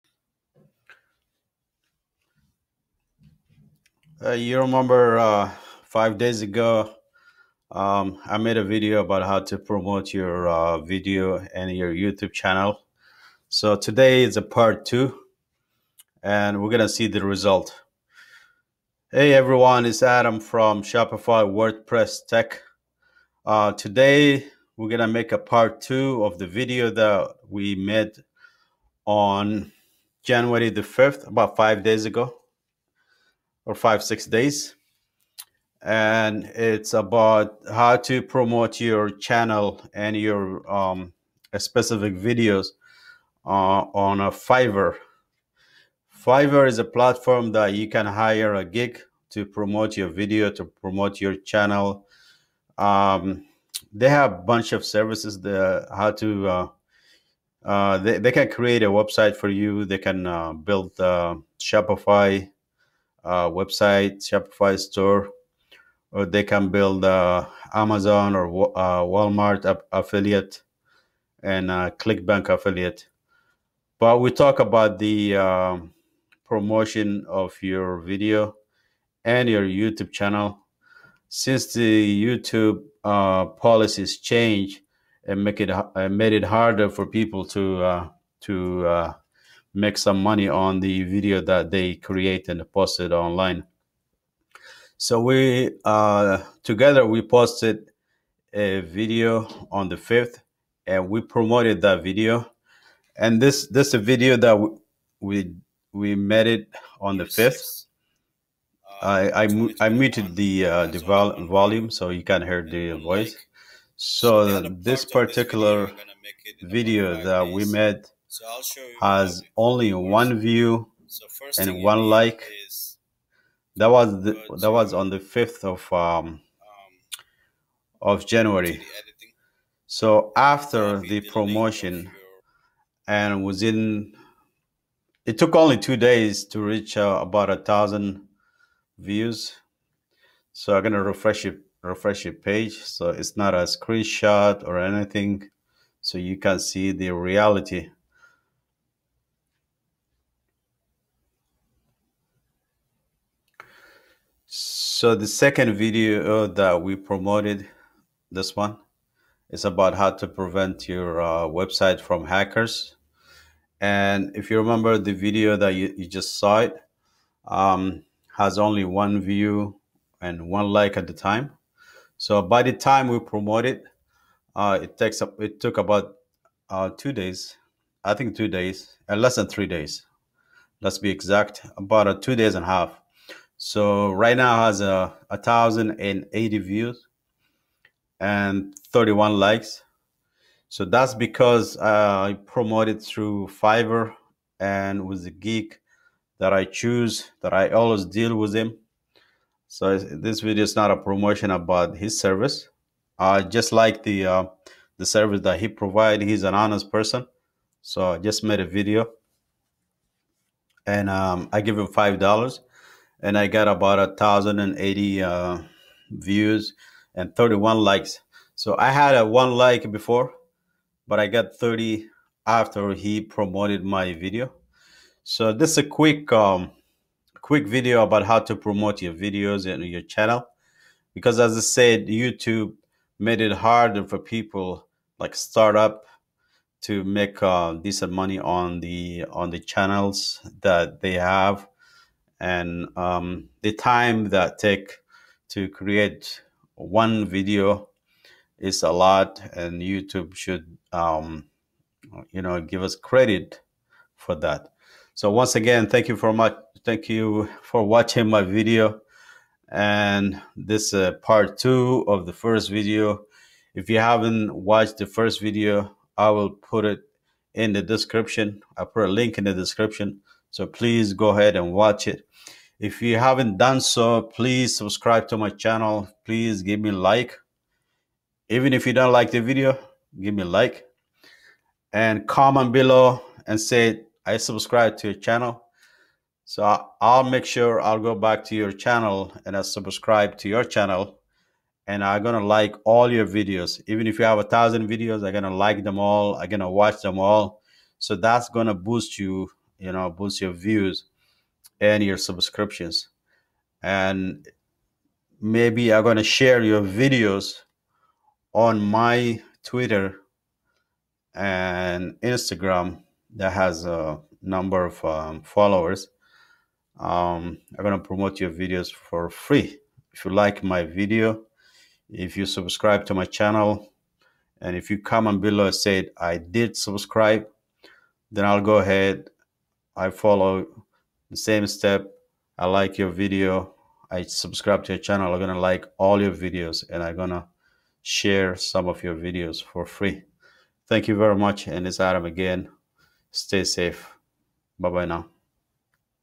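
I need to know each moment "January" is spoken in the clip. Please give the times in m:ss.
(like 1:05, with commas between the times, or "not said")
0:30, 2:08.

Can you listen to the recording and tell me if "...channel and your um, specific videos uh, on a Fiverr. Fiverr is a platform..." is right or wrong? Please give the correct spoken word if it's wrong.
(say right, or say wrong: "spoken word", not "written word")
right.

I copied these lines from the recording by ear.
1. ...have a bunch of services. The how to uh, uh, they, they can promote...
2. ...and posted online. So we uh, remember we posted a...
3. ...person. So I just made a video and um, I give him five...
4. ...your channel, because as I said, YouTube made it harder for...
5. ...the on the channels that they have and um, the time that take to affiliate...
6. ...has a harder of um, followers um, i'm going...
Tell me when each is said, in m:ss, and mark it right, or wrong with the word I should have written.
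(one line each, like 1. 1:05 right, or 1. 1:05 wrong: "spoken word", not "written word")
1. 0:54 wrong: "create", not "promote"
2. 1:32 wrong: "together", not "remember"
3. 3:26 right
4. 3:49 right
5. 3:58 wrong: "create", not "affiliate"
6. 5:13 wrong: "number", not "harder".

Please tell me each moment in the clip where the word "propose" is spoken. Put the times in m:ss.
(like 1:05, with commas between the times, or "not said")
not said.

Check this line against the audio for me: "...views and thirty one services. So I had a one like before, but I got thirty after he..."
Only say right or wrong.
wrong.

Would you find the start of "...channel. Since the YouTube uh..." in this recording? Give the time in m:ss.
1:20.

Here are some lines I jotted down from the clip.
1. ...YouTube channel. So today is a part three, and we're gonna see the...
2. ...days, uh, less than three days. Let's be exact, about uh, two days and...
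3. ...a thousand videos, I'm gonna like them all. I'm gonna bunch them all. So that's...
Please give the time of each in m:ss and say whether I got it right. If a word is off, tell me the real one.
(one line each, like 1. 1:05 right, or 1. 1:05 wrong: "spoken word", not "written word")
1. 0:11 wrong: "two", not "three"
2. 2:58 right
3. 4:54 wrong: "watch", not "bunch".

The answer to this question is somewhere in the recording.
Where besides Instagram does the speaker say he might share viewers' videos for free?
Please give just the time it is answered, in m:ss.
5:09.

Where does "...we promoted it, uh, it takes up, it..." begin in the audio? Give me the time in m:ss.
2:53.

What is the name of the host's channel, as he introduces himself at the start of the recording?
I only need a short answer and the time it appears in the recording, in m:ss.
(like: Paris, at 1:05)
Shopify WordPress Tech, at 0:20.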